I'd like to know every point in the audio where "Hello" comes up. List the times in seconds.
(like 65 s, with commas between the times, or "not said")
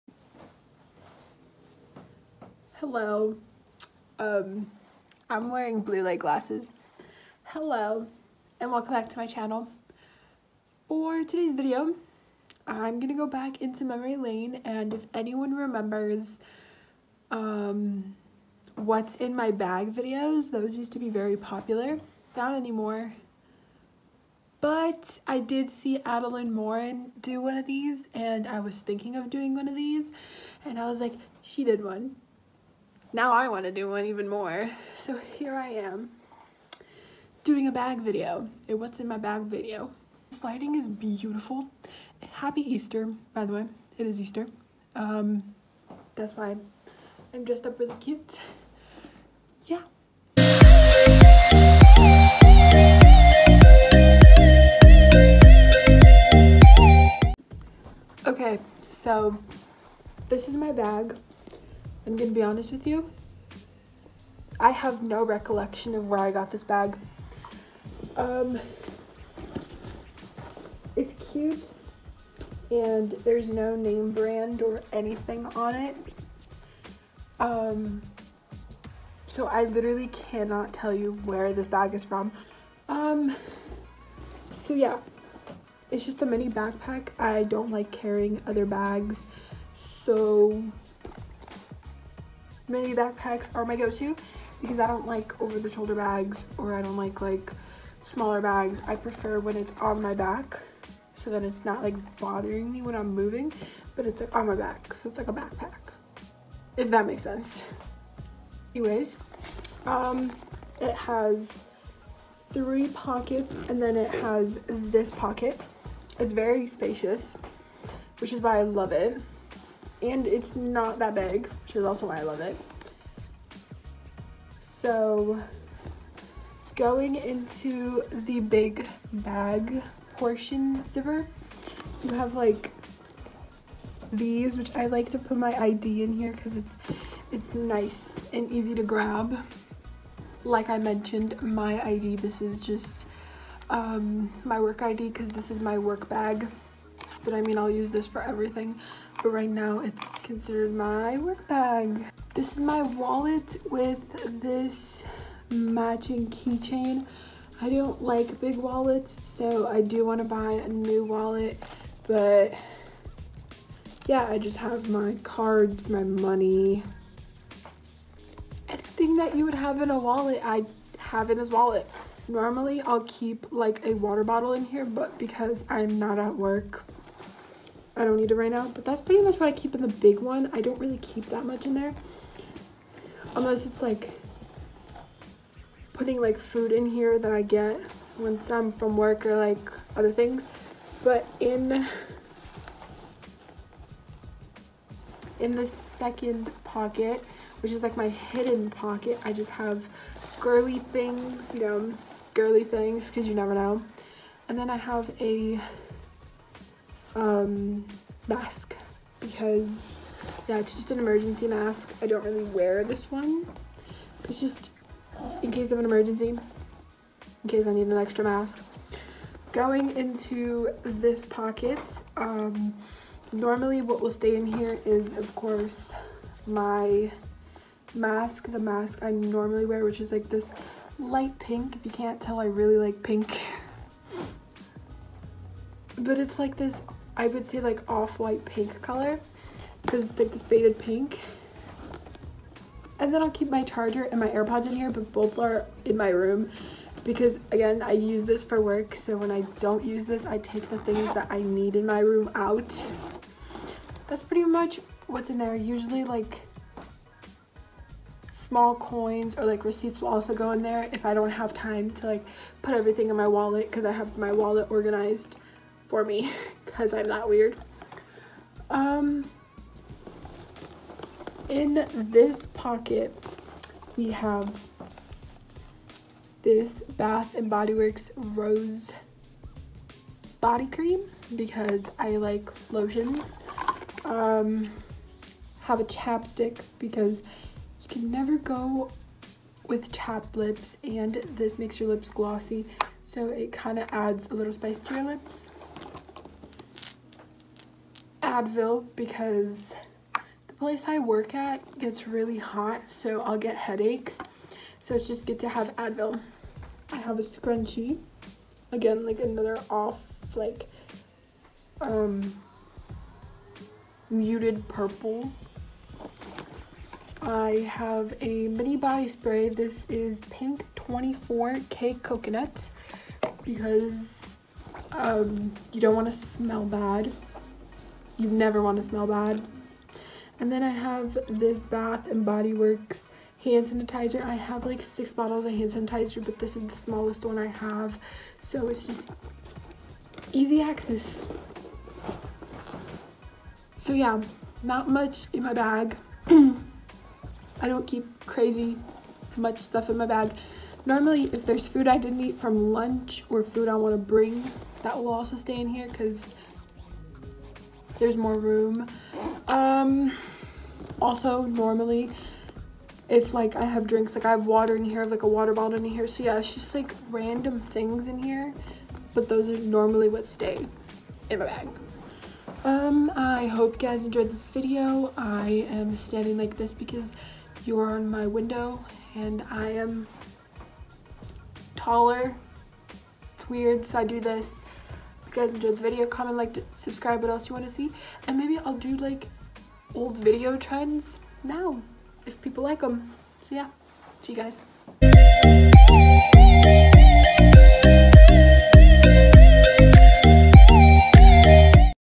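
2 s, 7 s.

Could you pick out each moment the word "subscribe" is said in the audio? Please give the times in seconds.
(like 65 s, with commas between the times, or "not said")
386 s.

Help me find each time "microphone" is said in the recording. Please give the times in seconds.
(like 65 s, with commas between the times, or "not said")
not said.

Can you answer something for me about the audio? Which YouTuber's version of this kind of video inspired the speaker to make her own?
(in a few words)
Adelaine Morin.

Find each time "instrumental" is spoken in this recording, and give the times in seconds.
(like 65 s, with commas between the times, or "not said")
not said.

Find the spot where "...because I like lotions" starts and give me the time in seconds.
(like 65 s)
281 s.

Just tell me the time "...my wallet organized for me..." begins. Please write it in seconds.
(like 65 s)
264 s.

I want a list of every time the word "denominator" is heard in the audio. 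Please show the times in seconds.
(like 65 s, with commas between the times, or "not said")
not said.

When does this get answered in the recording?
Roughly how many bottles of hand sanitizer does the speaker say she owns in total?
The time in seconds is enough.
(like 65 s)
334 s.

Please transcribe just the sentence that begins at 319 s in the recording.
This is Pink 24K coconut because um, you don't want to smell bad you never want to smell bad.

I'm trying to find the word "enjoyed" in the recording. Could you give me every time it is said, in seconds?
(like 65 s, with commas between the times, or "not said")
374 s, 385 s.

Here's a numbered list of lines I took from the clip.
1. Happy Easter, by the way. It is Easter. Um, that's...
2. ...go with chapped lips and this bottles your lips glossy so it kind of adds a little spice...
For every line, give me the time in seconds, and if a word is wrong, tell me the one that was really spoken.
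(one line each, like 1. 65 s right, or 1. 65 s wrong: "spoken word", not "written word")
1. 42 s right
2. 288 s wrong: "makes", not "bottles".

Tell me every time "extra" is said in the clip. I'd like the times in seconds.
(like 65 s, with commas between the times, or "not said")
217 s.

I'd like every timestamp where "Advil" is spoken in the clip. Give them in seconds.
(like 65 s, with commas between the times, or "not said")
298 s, 305 s.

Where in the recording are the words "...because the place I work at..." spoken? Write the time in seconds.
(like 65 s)
298 s.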